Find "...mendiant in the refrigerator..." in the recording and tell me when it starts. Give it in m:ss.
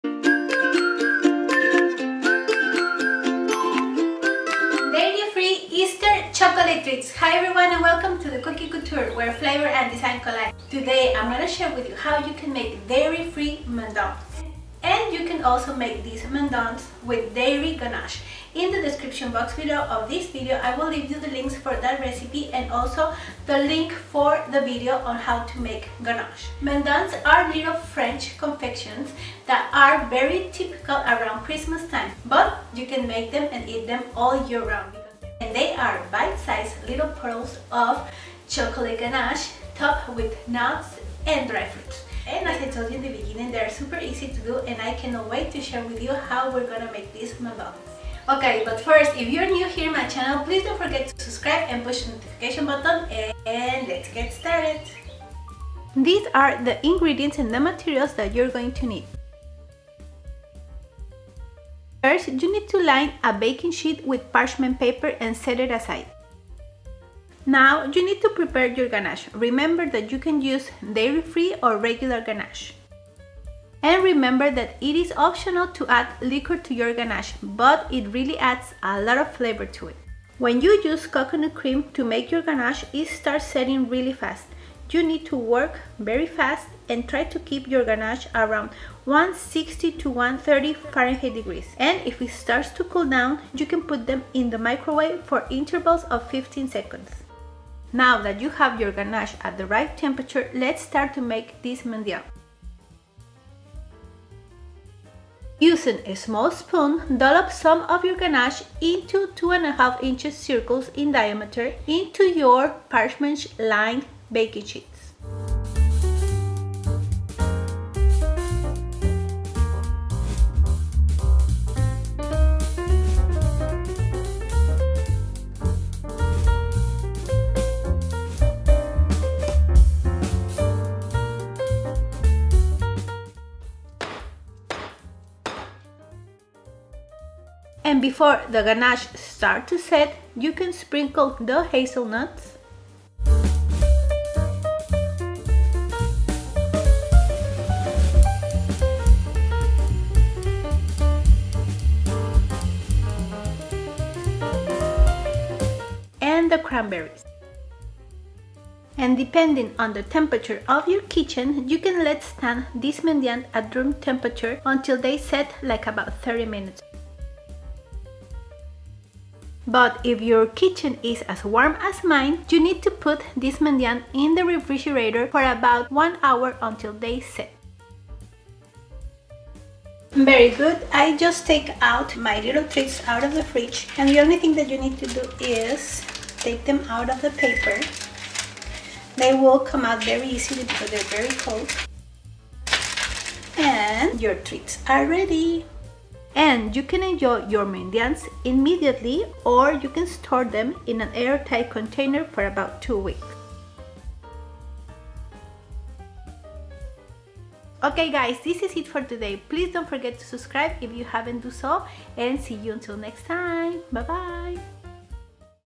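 2:53.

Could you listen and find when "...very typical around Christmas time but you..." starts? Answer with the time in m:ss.
0:30.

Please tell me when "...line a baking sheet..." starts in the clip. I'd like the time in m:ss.
1:02.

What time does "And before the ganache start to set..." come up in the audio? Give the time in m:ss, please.
2:17.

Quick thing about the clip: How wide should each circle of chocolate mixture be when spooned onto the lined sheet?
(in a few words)
2.5 inches.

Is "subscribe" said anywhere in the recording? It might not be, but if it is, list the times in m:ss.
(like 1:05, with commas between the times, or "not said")
0:51, 3:30.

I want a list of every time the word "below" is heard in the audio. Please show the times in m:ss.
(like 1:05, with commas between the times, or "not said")
0:19.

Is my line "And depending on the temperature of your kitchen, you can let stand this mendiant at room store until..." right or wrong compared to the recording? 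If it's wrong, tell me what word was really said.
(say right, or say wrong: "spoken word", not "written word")
wrong: "temperature", not "store".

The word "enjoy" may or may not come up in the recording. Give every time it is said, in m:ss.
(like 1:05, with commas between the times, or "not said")
3:17.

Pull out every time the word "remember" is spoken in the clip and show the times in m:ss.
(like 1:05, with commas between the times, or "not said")
1:09, 1:14.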